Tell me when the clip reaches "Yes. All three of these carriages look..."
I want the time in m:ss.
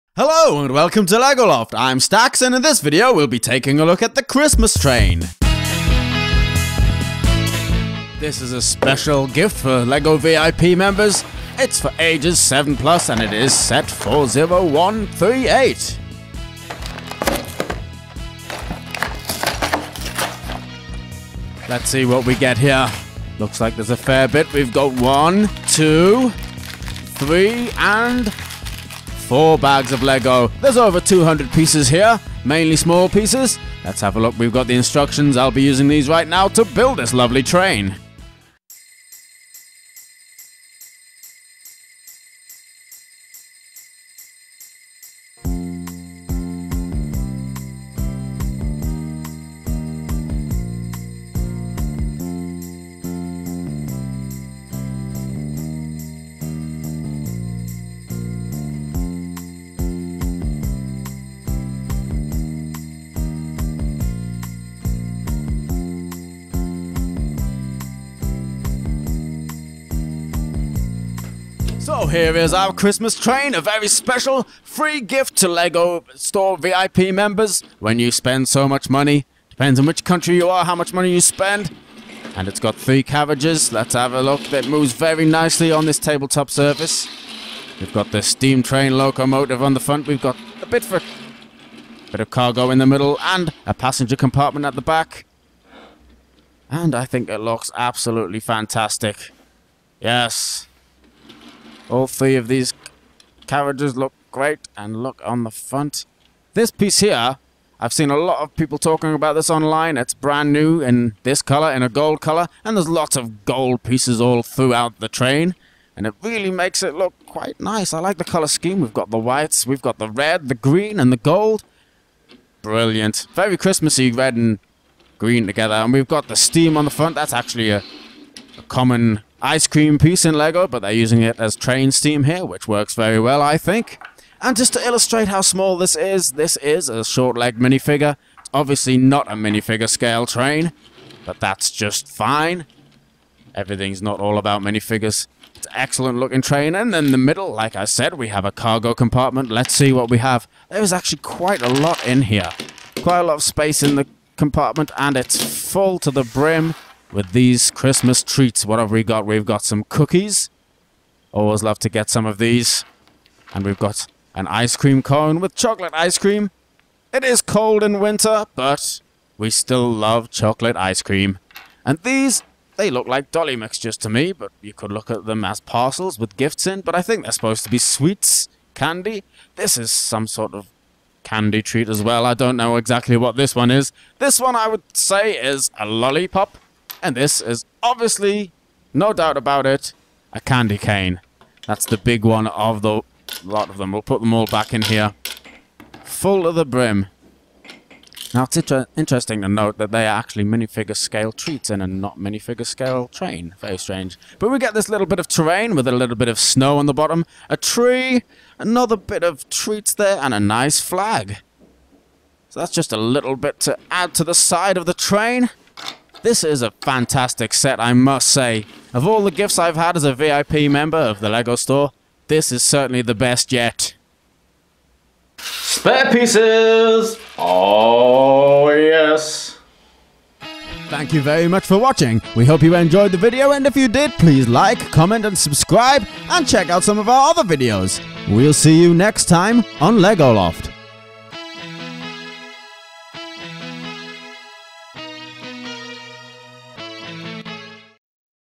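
1:39.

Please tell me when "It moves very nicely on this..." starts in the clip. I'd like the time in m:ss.
1:24.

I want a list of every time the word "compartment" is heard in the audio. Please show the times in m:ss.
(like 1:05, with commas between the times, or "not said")
1:34, 2:28, 2:34.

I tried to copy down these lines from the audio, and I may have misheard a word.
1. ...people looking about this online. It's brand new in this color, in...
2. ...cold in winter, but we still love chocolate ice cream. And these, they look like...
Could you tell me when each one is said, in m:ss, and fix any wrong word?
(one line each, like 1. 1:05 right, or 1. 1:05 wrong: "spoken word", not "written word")
1. 1:48 wrong: "talking", not "looking"
2. 2:47 right.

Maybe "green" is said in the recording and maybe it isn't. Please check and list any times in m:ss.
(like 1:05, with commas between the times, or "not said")
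2:00, 2:05.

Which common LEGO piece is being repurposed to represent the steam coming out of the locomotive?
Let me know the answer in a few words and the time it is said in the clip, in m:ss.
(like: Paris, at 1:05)
ice cream piece, at 2:09.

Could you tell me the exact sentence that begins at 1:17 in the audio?
When you spend so much money, depends on which country you are, how much money you spend.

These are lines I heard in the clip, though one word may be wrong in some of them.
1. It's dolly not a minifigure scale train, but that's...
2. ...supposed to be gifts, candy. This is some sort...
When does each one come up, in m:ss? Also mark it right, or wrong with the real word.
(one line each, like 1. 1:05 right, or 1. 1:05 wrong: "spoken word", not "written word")
1. 2:18 wrong: "obviously", not "dolly"
2. 2:57 wrong: "sweets", not "gifts".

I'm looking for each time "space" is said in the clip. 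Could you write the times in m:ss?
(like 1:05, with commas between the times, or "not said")
2:33.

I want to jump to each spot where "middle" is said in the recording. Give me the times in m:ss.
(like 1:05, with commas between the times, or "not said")
1:32, 2:27.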